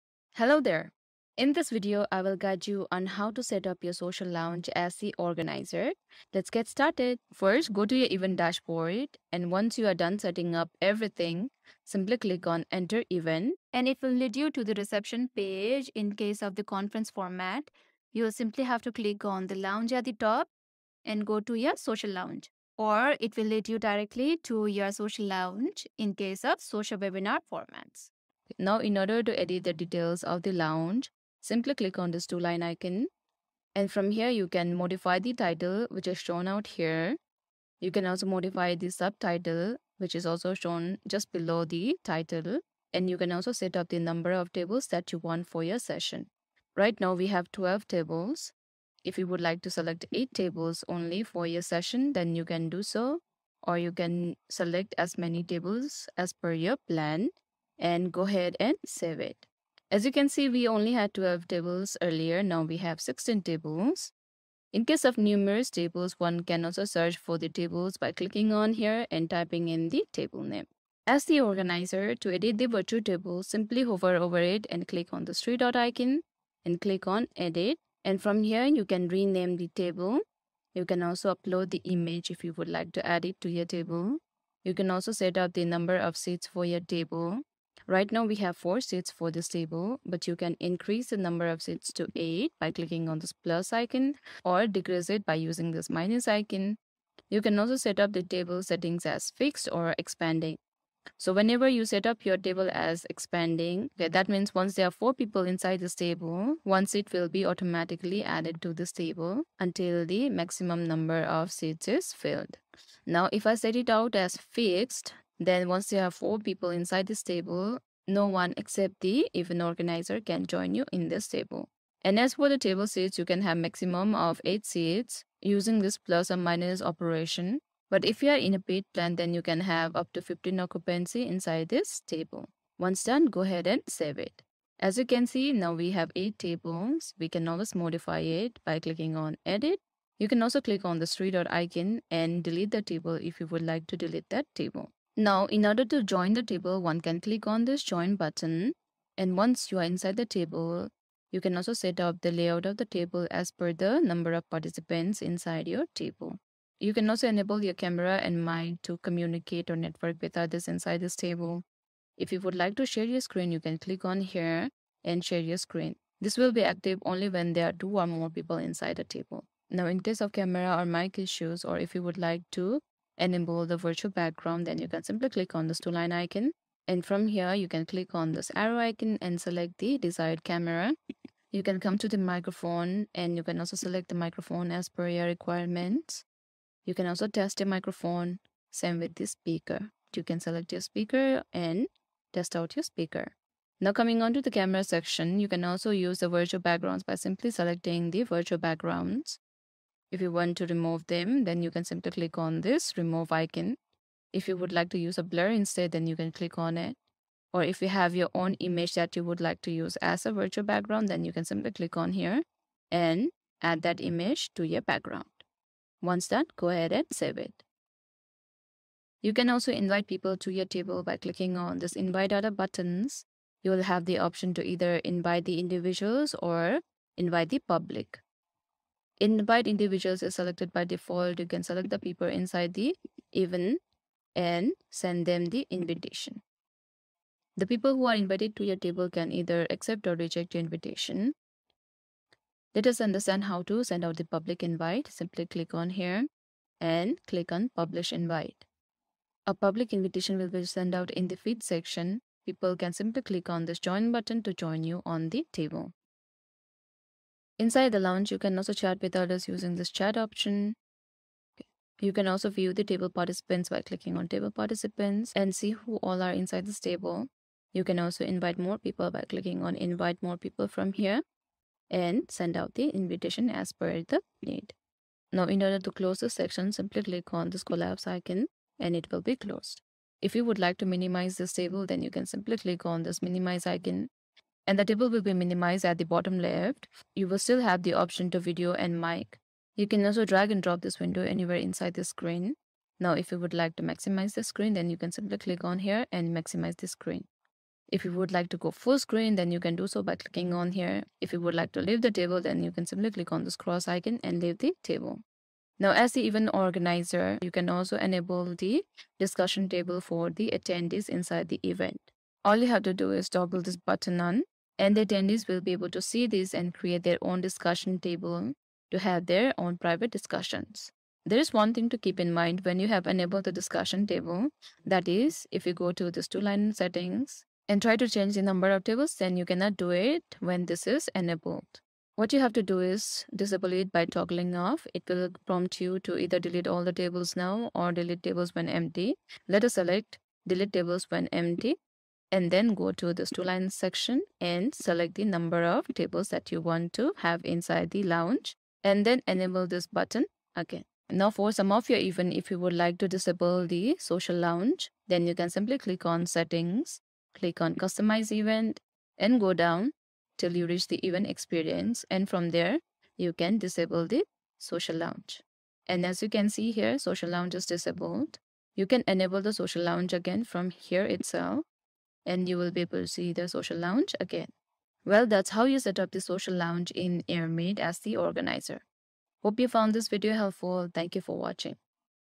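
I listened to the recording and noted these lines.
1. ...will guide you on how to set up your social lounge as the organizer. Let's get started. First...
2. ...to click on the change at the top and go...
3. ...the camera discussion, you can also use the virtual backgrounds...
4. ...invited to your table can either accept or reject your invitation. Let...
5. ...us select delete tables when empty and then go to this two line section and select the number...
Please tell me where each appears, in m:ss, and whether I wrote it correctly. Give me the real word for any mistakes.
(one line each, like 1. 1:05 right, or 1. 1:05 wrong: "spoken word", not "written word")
1. 0:02 right
2. 0:18 wrong: "lounge", not "change"
3. 3:14 wrong: "section", not "discussion"
4. 3:58 right
5. 5:39 right.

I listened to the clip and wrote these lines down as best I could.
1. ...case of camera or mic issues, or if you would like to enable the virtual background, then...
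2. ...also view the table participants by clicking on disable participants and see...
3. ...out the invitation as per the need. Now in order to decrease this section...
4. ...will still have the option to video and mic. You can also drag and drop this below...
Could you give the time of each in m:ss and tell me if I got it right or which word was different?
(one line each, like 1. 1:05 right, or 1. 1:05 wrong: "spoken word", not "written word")
1. 2:49 right
2. 4:22 wrong: "table", not "disable"
3. 4:32 wrong: "close", not "decrease"
4. 4:47 wrong: "window", not "below".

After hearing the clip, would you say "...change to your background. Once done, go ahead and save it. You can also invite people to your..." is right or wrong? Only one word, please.
wrong.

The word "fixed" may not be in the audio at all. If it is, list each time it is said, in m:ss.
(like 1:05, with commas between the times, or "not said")
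1:39, 1:54.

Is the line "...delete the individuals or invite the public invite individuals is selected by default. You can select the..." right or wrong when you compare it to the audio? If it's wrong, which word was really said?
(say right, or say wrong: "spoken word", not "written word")
wrong: "invite", not "delete".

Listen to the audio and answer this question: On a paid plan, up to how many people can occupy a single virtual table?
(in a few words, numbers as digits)
15.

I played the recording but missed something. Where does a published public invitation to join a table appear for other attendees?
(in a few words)
the feed section.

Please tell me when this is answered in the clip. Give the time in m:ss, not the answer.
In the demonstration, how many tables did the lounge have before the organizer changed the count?
0:46.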